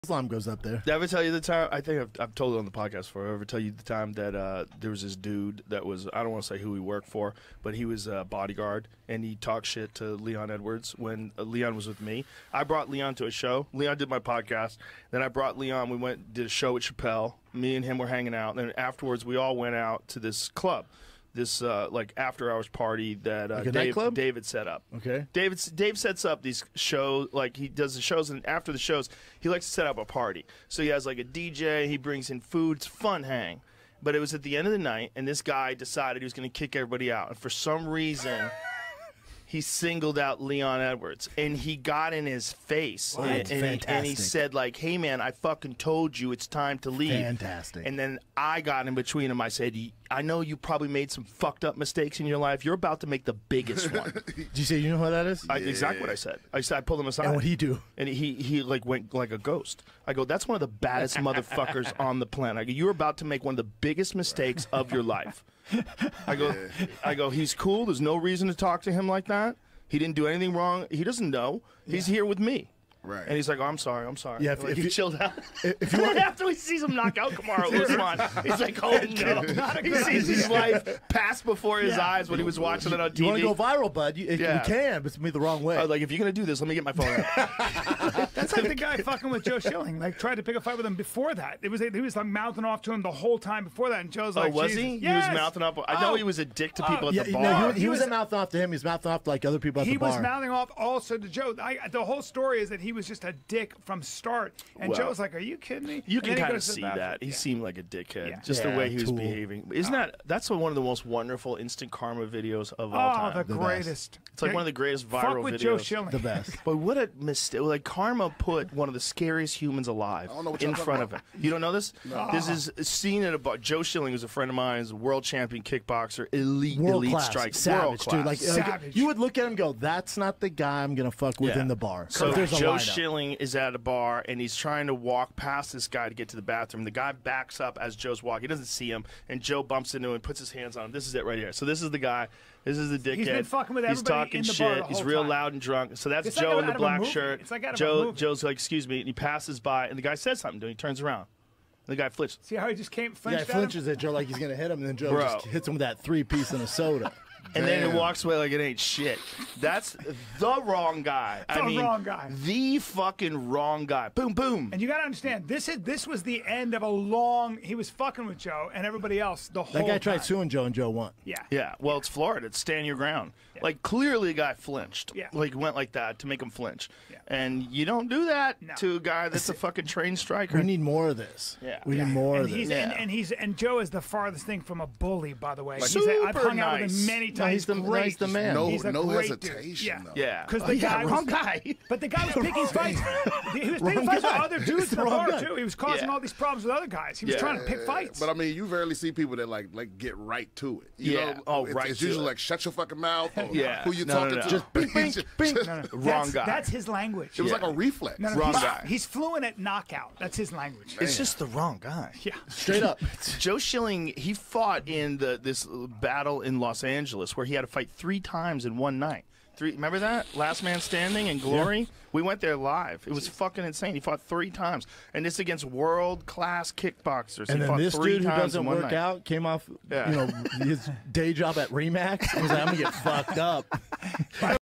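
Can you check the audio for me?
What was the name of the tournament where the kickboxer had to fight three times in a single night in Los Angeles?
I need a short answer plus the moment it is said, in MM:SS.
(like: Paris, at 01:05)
Last Man Standing, at 03:40.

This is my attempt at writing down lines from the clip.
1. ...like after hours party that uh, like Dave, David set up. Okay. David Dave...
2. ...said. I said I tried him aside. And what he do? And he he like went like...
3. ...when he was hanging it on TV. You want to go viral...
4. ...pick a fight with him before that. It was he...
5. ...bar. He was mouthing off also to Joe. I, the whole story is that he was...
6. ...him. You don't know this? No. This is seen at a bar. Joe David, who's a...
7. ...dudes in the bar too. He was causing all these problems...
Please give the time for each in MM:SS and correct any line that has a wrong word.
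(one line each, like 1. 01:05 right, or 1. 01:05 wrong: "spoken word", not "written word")
1. 00:21 right
2. 00:56 wrong: "pulled", not "tried"
3. 01:22 wrong: "watching", not "hanging"
4. 01:30 right
5. 01:39 right
6. 02:01 wrong: "Schilling", not "David"
7. 03:14 right.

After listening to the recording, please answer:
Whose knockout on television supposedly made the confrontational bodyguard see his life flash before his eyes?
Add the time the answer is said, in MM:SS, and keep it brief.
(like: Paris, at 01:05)
Kamaru Usman, at 01:17.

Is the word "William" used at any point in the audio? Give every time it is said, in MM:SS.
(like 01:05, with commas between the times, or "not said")
not said.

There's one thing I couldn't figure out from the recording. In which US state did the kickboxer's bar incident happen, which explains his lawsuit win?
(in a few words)
Florida.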